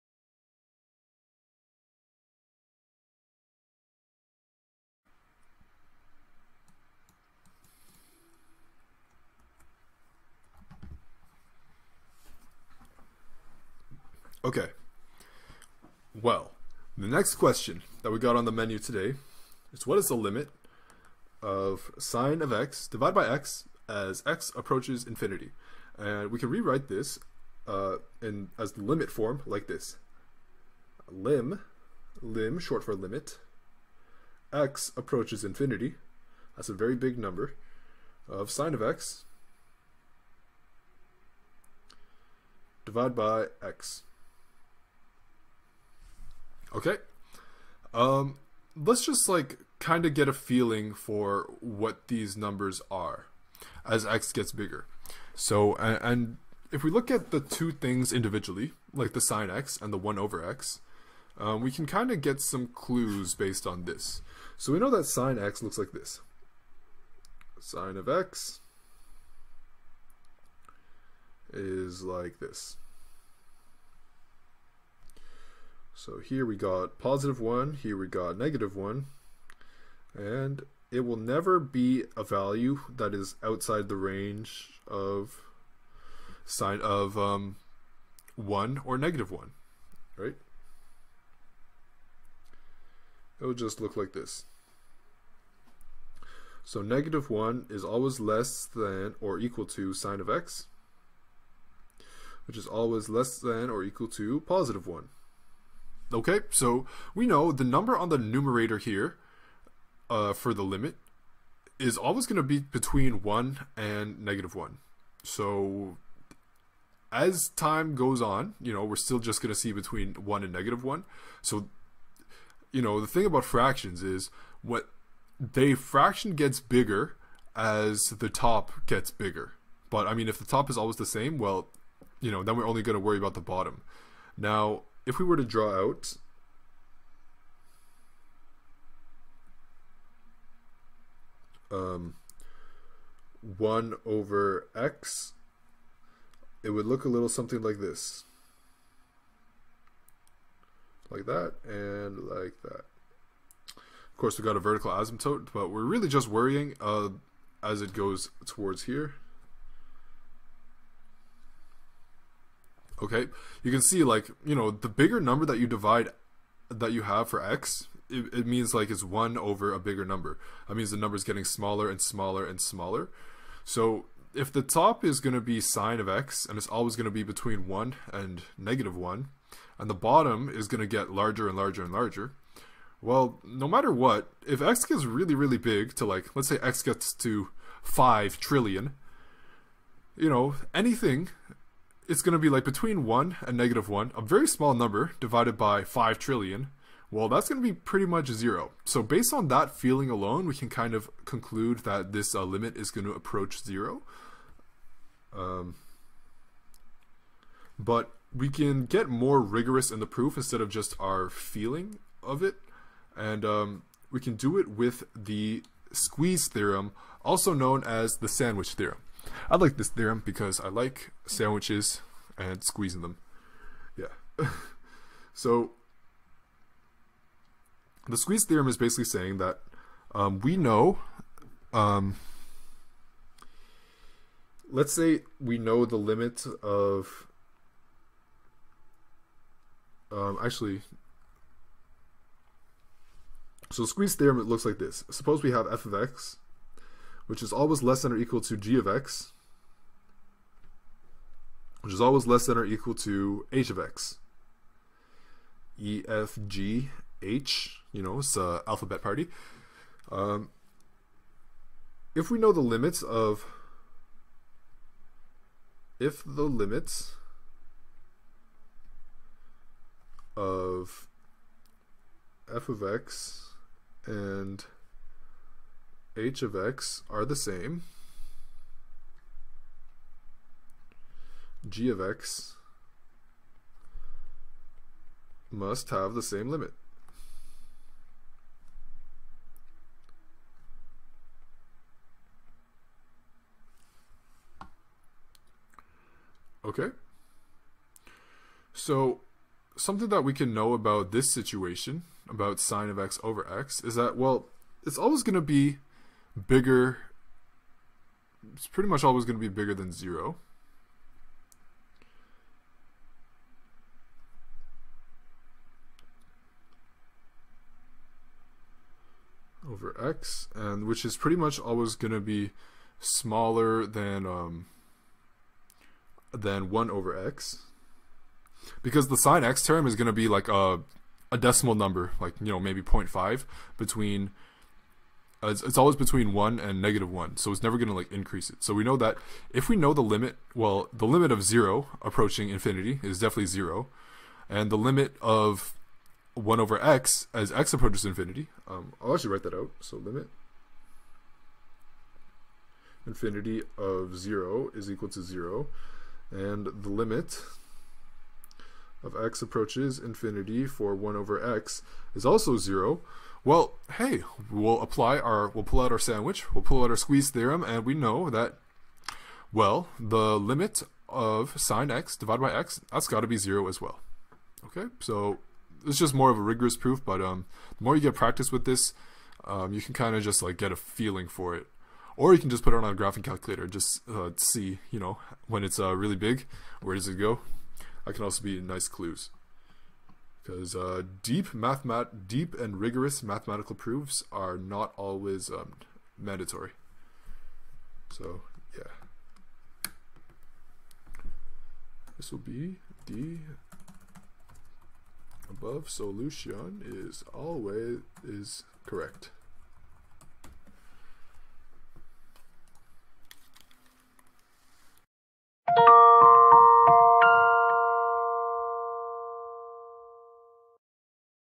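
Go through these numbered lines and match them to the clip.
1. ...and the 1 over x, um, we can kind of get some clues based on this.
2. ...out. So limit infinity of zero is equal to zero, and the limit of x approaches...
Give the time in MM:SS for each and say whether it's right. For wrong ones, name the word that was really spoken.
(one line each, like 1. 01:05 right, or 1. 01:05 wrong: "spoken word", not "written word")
1. 00:59 right
2. 05:49 right.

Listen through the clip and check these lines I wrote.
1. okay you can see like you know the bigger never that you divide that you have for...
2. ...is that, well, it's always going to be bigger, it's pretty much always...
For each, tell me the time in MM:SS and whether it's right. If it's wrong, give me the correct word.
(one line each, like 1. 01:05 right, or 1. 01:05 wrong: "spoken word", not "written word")
1. 02:43 wrong: "number", not "never"
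2. 05:03 right.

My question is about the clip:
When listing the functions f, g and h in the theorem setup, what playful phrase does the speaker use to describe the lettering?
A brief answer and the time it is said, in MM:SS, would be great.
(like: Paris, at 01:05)
alphabet party, at 04:18.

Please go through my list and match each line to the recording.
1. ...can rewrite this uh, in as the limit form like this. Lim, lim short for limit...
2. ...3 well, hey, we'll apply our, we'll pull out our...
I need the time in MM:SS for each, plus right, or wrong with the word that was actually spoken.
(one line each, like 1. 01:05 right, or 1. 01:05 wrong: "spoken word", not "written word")
1. 00:26 right
2. 06:02 wrong: "0", not "3".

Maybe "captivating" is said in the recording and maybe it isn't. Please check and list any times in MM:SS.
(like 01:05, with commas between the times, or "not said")
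not said.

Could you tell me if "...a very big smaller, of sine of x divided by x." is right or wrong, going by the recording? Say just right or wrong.
wrong.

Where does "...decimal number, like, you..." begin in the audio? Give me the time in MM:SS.
05:31.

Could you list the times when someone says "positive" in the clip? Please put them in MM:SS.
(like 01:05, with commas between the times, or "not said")
01:16, 01:44.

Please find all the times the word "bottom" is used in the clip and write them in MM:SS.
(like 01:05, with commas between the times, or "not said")
02:13, 02:59.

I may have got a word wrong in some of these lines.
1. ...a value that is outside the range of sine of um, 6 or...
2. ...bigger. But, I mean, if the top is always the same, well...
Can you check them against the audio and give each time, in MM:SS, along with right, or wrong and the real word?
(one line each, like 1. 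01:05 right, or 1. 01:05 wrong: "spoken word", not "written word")
1. 01:22 wrong: "1", not "6"
2. 02:09 right.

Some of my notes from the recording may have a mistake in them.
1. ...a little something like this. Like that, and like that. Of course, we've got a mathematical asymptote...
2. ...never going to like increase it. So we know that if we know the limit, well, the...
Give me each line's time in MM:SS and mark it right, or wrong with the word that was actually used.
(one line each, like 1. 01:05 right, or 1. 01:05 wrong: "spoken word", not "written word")
1. 02:27 wrong: "vertical", not "mathematical"
2. 05:37 right.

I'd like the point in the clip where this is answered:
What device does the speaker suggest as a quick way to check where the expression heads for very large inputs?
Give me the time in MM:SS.
06:22.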